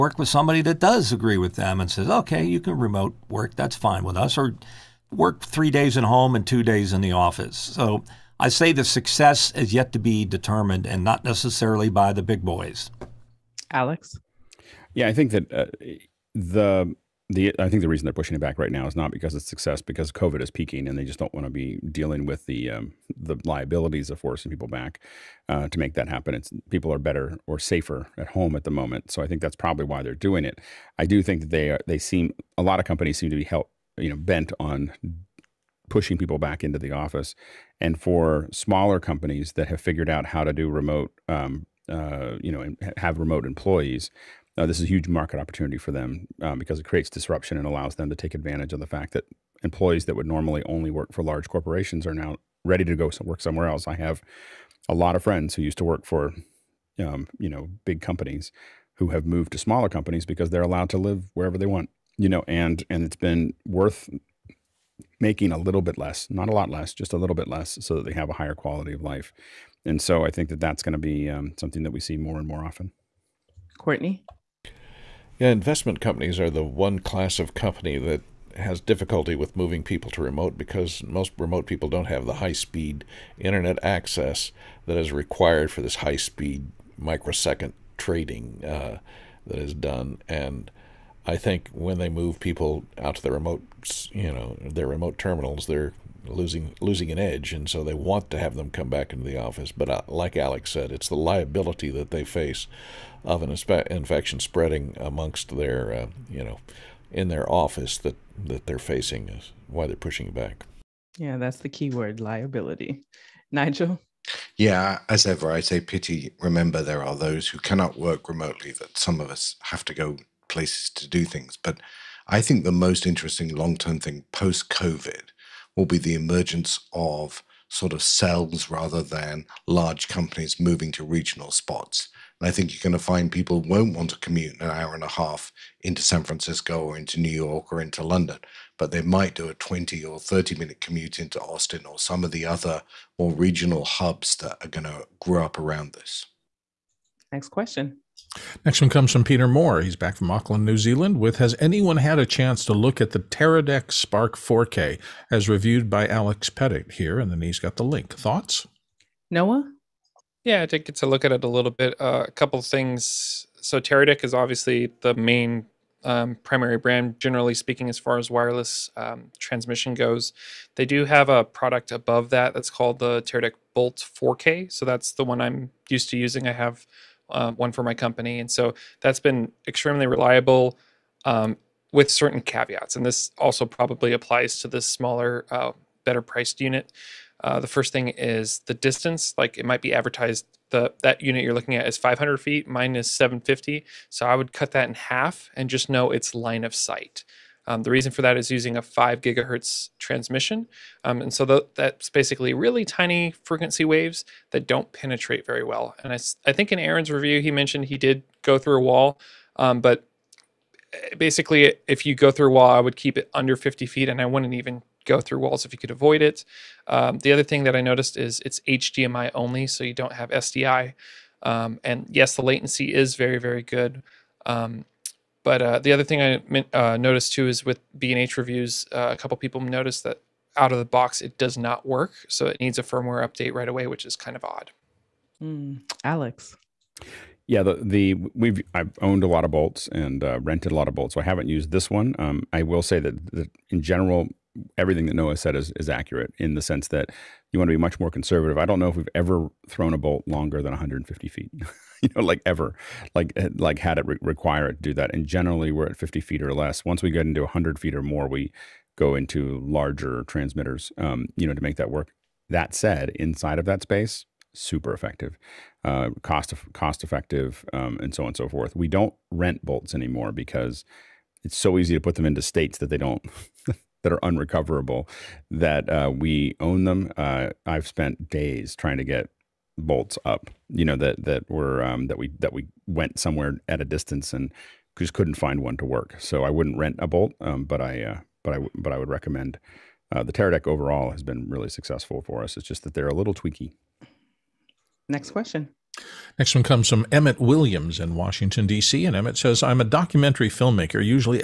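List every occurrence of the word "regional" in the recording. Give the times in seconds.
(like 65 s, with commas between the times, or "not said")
131 s, 143 s.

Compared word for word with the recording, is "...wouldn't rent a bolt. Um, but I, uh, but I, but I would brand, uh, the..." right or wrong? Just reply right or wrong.
wrong.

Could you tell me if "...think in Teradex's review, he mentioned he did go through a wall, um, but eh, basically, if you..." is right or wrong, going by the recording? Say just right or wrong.
wrong.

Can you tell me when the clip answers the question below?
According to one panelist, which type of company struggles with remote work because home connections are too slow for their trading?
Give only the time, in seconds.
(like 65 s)
75 s.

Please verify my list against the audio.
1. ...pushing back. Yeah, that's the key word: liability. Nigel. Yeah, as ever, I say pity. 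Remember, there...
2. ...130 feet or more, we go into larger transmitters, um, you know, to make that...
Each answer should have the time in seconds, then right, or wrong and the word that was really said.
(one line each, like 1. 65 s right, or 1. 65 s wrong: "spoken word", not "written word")
1. 109 s right
2. 257 s wrong: "100", not "130".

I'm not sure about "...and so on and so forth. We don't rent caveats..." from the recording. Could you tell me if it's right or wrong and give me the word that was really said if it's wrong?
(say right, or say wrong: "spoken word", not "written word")
wrong: "bolts", not "caveats".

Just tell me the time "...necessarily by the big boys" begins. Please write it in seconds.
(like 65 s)
11 s.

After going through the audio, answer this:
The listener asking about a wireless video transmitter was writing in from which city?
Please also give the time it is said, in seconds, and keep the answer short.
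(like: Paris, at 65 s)
Auckland, at 150 s.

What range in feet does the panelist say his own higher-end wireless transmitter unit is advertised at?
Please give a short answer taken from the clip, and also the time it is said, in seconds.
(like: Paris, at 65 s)
750, at 193 s.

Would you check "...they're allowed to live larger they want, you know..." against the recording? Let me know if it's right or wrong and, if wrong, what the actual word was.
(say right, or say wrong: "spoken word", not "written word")
wrong: "wherever", not "larger".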